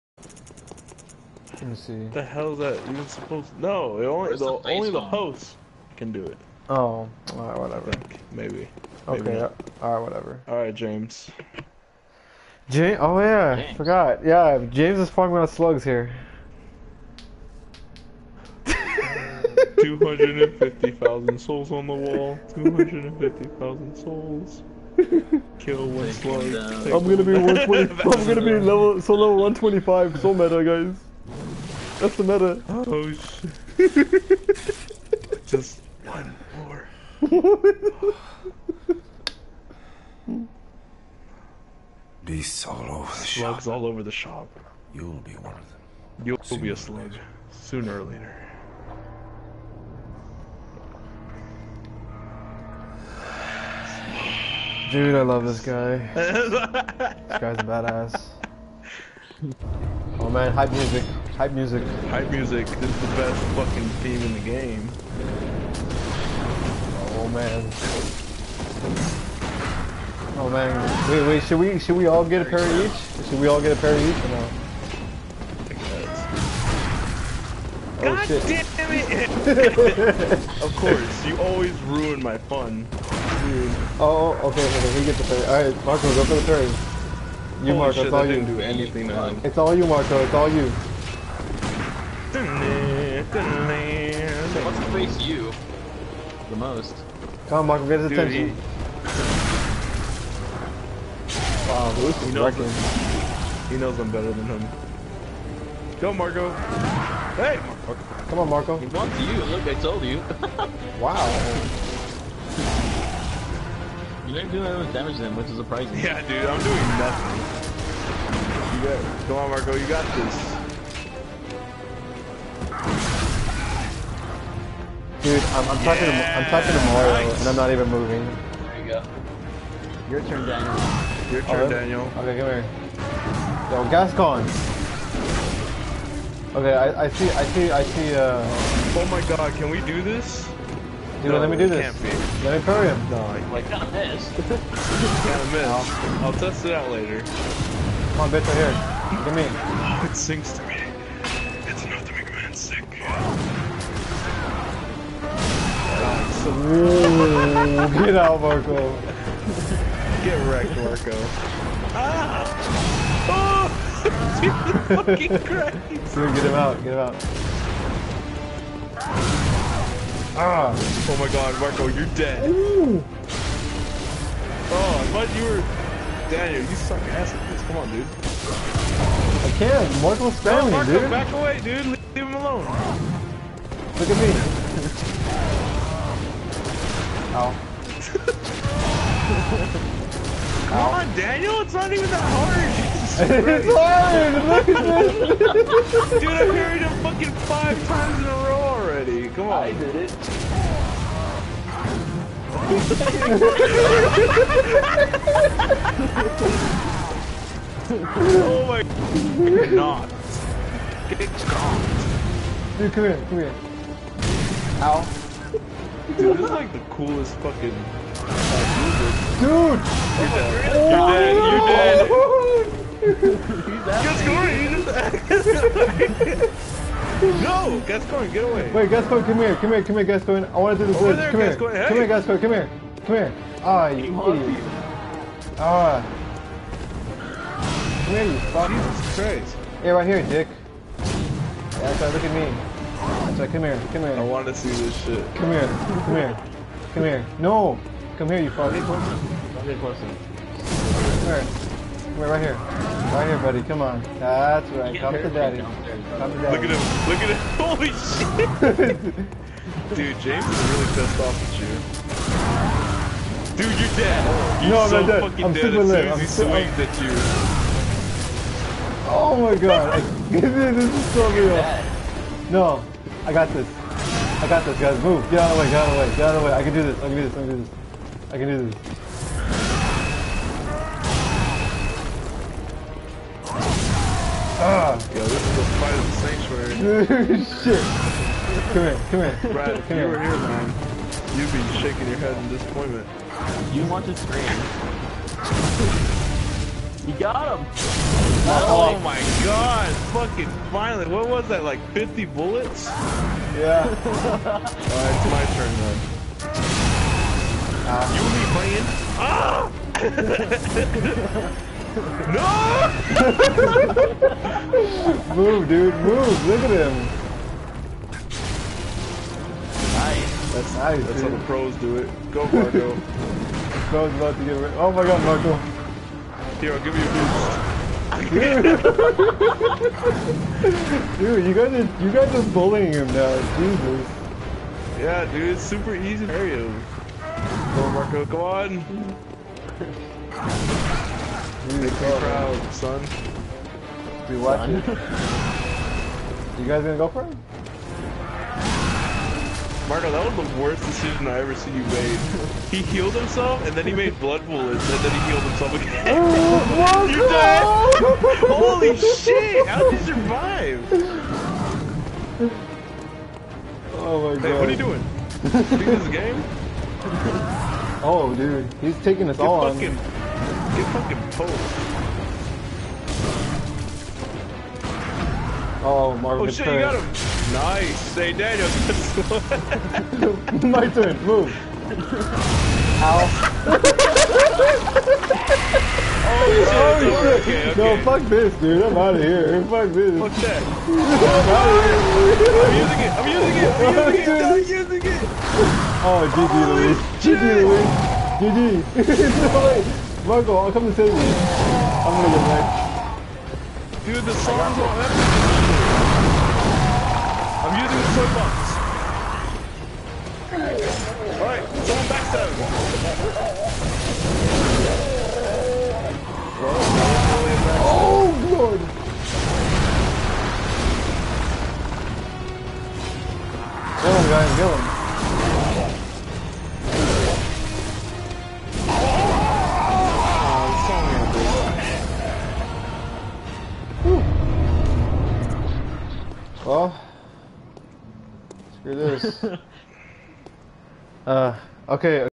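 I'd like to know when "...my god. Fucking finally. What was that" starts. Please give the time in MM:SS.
04:58.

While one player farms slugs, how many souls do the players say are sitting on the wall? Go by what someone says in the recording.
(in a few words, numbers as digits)
250,000.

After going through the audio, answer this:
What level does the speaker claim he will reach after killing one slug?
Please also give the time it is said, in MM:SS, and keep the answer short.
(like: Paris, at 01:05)
125, at 00:29.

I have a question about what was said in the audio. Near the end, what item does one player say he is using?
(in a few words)
the toy box.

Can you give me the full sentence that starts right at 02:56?
Daniel, you suck ass at this.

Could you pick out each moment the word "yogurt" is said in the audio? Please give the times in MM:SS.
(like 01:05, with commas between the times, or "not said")
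not said.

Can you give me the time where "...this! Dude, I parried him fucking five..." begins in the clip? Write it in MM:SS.
03:14.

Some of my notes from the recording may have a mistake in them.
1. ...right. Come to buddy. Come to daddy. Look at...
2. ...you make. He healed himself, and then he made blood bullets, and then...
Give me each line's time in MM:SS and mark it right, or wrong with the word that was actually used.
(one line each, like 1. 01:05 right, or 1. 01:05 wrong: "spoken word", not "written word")
1. 04:14 wrong: "daddy", not "buddy"
2. 05:51 right.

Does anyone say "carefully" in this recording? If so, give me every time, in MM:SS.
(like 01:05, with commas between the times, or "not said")
not said.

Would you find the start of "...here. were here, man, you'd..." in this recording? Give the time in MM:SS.
04:50.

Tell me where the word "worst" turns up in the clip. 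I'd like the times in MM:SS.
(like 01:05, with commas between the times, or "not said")
05:50.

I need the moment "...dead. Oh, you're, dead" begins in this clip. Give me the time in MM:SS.
03:40.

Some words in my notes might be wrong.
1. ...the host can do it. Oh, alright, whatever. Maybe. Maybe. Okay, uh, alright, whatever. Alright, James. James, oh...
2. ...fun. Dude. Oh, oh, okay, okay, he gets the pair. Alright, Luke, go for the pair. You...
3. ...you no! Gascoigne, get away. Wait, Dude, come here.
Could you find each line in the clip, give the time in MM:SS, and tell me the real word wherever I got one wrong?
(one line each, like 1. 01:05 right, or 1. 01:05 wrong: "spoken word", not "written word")
1. 00:04 right
2. 01:22 wrong: "Marco", not "Luke"
3. 03:47 wrong: "Gascoigne", not "Dude".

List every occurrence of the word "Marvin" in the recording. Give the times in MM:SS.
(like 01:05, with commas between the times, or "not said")
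06:16.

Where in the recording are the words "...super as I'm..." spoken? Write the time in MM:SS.
04:25.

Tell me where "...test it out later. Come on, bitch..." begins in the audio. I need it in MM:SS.
02:26.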